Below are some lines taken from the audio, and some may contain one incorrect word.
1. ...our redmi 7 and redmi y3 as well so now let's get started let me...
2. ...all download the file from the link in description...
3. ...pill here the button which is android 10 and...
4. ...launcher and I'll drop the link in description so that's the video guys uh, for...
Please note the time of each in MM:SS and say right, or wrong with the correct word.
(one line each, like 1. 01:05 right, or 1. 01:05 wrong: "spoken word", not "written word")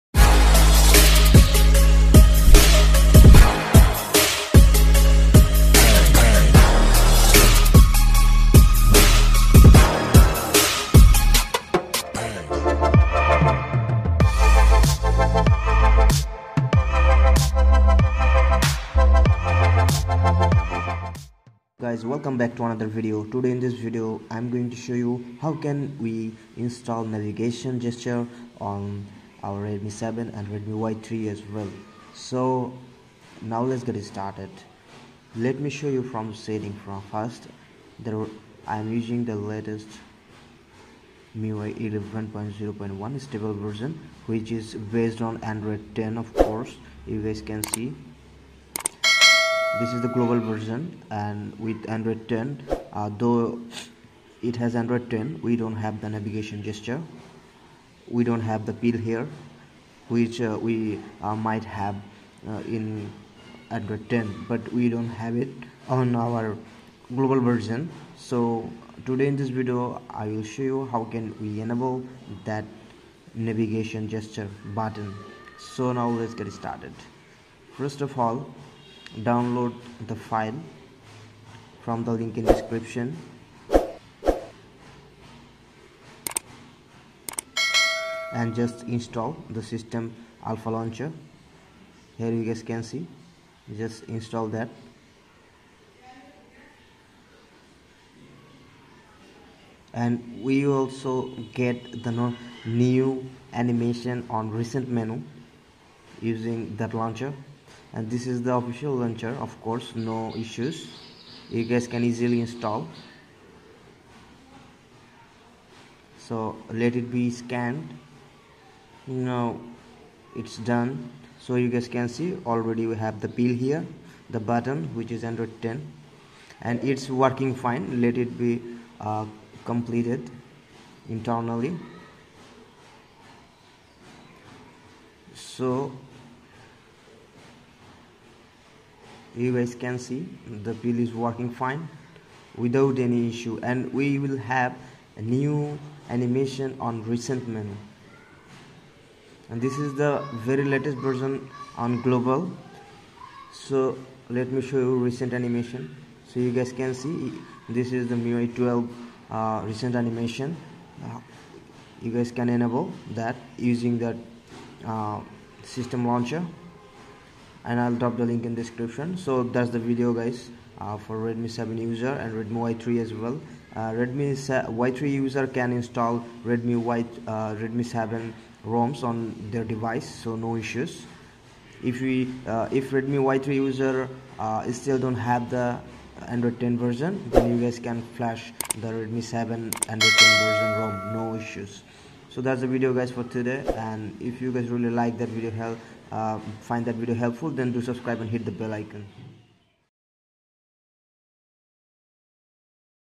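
1. 00:29 right
2. 01:18 right
3. 02:03 right
4. 02:46 right.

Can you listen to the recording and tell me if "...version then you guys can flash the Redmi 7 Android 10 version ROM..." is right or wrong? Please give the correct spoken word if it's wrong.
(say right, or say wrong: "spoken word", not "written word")
right.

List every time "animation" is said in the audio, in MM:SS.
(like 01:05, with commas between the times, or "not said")
01:43, 02:26, 02:35, 02:39.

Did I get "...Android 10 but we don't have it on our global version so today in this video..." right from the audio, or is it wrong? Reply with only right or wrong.
right.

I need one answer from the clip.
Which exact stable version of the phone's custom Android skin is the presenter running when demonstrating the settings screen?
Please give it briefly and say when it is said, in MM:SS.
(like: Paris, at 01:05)
MIUI 11.0.1, at 00:41.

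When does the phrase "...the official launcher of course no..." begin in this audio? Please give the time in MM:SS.
01:48.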